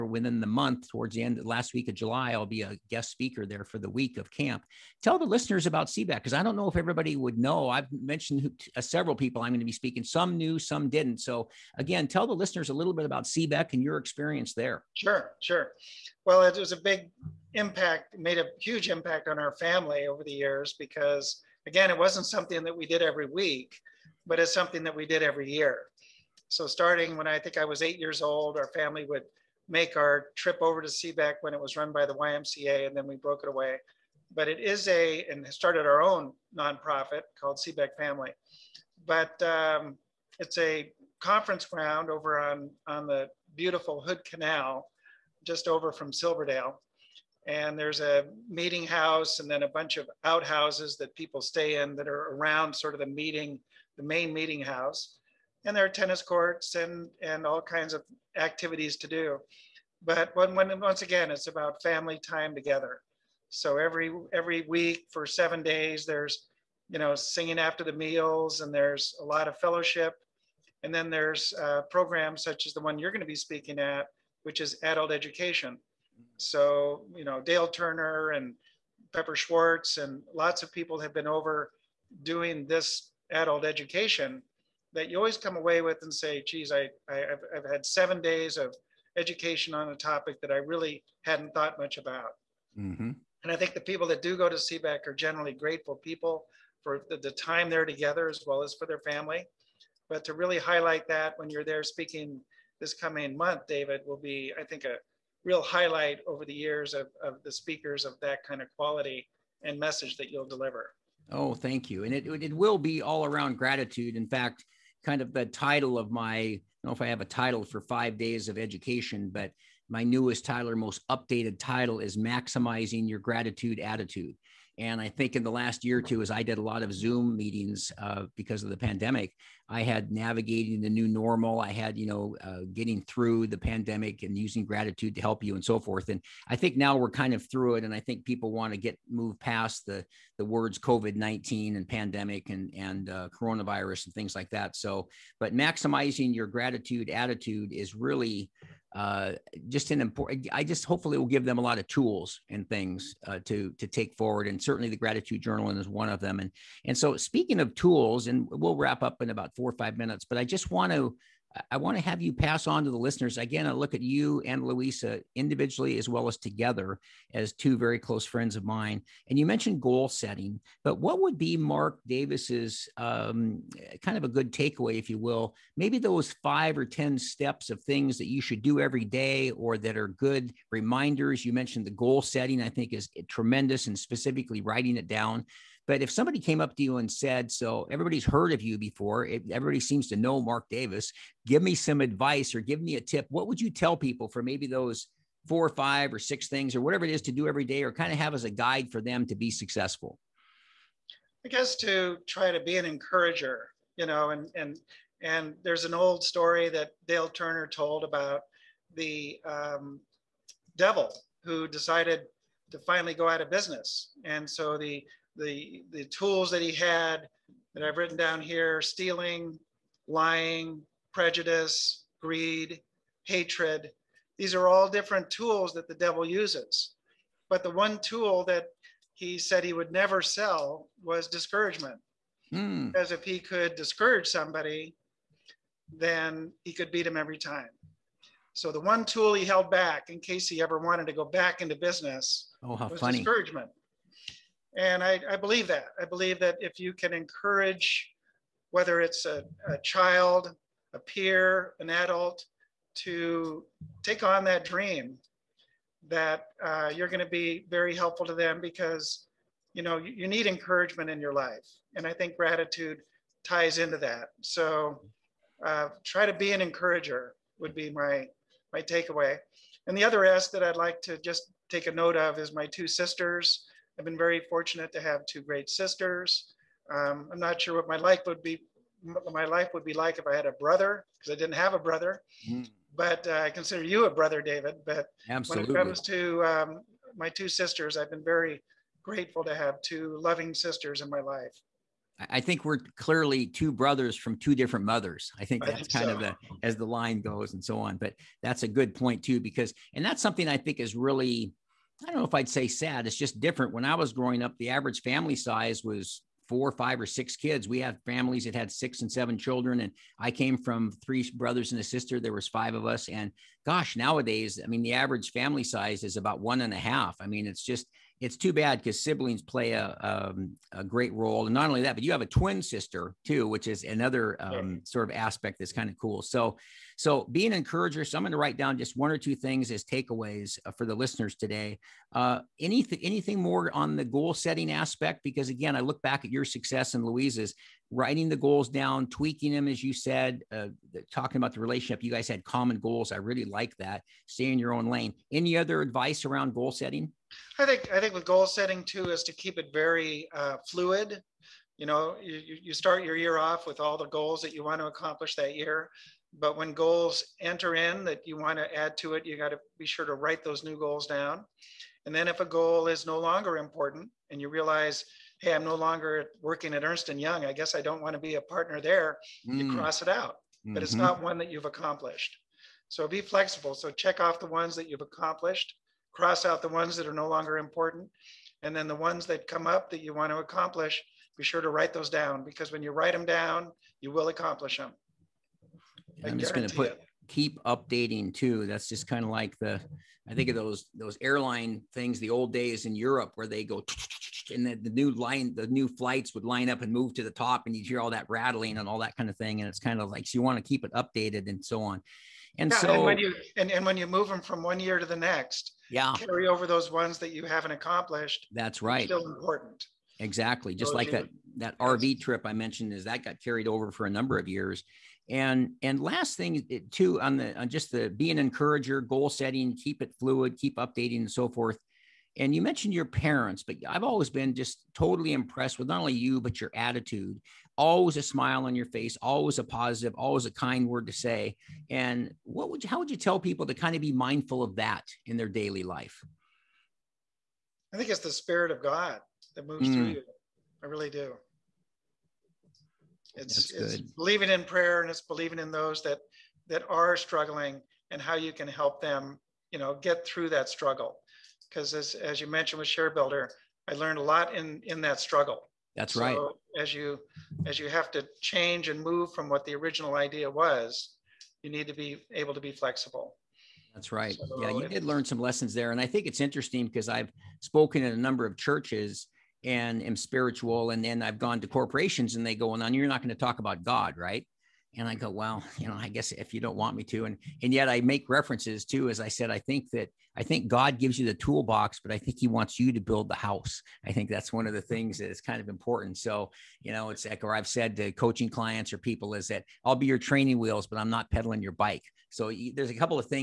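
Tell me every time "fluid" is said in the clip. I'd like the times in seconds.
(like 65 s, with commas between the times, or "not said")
350 s, 420 s.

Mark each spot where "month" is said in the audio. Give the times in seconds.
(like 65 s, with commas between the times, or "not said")
0 s, 103 s.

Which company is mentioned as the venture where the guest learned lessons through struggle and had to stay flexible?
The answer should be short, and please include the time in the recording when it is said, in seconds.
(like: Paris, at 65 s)
ShareBuilder, at 452 s.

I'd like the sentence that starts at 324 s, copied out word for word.
sort of aspect that's kind of cool.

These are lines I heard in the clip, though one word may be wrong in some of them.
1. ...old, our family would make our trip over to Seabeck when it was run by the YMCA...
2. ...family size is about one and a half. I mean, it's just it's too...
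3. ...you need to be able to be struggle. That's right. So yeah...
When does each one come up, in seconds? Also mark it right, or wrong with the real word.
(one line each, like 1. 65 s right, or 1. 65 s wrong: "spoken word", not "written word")
1. 28 s right
2. 315 s right
3. 461 s wrong: "flexible", not "struggle".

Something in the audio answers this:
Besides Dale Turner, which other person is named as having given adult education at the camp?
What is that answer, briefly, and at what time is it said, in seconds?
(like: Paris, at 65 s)
Pepper Schwartz, at 79 s.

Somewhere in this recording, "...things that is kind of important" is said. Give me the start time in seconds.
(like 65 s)
484 s.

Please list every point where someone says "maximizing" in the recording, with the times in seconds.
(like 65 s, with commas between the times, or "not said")
122 s, 145 s.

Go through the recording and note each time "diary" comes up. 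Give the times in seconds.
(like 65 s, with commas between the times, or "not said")
not said.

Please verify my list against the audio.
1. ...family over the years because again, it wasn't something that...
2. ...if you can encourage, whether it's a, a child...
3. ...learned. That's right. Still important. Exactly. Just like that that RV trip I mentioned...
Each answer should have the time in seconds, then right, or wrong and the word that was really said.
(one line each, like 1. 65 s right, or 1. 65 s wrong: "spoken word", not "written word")
1. 19 s right
2. 246 s right
3. 407 s wrong: "accomplished", not "learned".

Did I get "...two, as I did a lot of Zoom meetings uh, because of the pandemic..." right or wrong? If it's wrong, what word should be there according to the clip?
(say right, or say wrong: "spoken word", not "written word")
right.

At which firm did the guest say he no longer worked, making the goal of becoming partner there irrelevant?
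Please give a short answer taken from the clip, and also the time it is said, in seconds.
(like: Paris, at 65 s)
Ernst and Young, at 366 s.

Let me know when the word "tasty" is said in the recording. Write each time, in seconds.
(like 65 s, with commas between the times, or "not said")
not said.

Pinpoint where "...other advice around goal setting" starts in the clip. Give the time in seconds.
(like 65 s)
345 s.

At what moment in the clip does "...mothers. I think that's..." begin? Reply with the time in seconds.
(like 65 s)
294 s.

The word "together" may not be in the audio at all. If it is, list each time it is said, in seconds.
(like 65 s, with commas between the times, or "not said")
62 s, 97 s, 166 s.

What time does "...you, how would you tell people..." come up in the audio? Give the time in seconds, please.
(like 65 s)
432 s.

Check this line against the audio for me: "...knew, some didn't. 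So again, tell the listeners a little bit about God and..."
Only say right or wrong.
wrong.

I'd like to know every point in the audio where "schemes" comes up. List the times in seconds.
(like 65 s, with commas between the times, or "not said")
not said.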